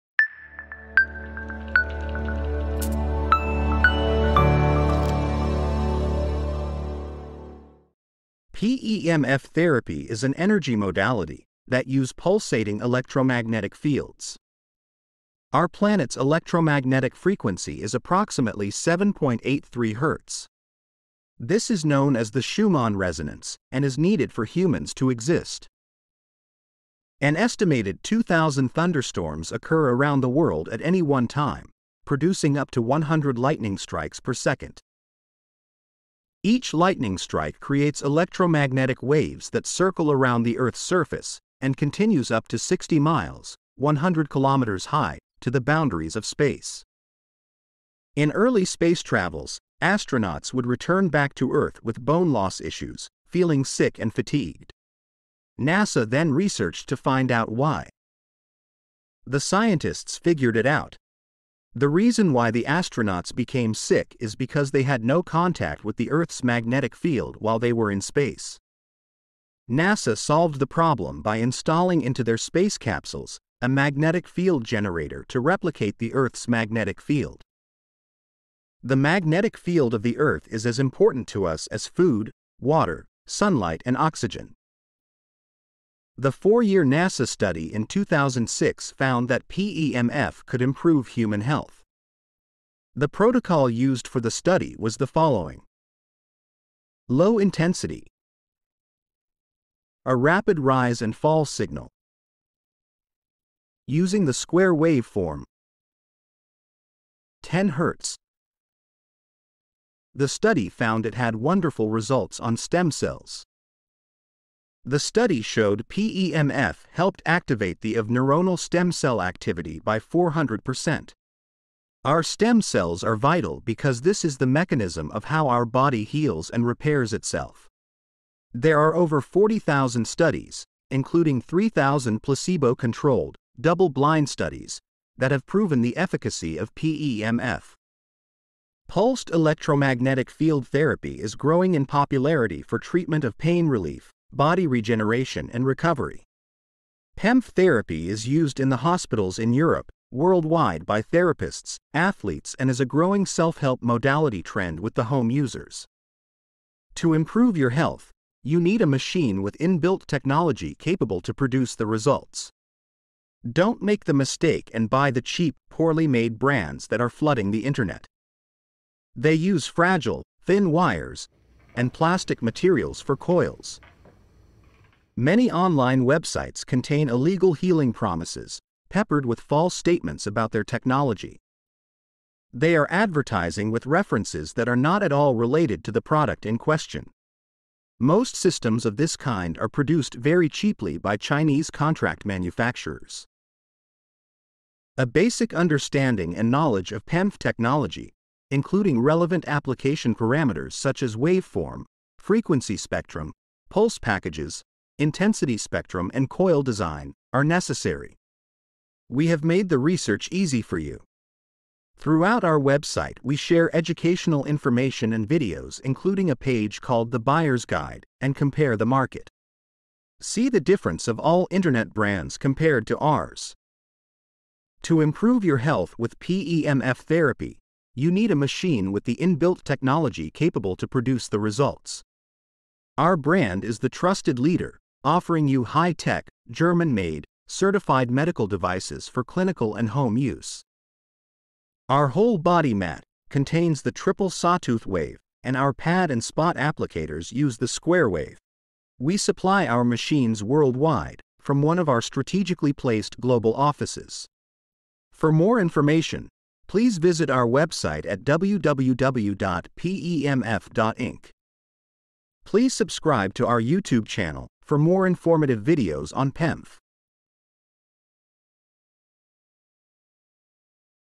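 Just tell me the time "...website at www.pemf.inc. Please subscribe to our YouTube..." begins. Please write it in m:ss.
4:17.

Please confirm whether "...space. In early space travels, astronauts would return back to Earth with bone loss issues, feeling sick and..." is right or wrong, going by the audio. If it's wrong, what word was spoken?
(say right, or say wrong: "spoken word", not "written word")
right.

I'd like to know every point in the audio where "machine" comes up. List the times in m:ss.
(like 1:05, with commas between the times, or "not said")
2:38, 3:48, 4:09.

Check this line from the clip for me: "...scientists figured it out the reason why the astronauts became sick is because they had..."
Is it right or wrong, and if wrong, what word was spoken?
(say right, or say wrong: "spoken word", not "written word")
right.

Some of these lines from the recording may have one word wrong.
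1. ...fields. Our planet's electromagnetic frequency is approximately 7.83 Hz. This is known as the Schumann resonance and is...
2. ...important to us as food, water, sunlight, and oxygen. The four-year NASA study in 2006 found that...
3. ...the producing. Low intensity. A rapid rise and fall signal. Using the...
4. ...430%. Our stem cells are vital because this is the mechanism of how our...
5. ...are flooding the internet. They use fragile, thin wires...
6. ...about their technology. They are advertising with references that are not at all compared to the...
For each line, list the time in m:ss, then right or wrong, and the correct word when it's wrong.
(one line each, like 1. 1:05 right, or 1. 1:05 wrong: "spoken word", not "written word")
1. 0:13 right
2. 1:20 right
3. 1:34 wrong: "following", not "producing"
4. 1:59 wrong: "400", not "430"
5. 2:47 right
6. 3:00 wrong: "related", not "compared".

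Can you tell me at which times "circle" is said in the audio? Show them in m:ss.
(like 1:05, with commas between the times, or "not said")
0:39.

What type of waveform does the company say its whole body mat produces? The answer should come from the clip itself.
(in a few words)
triple sawtooth wave.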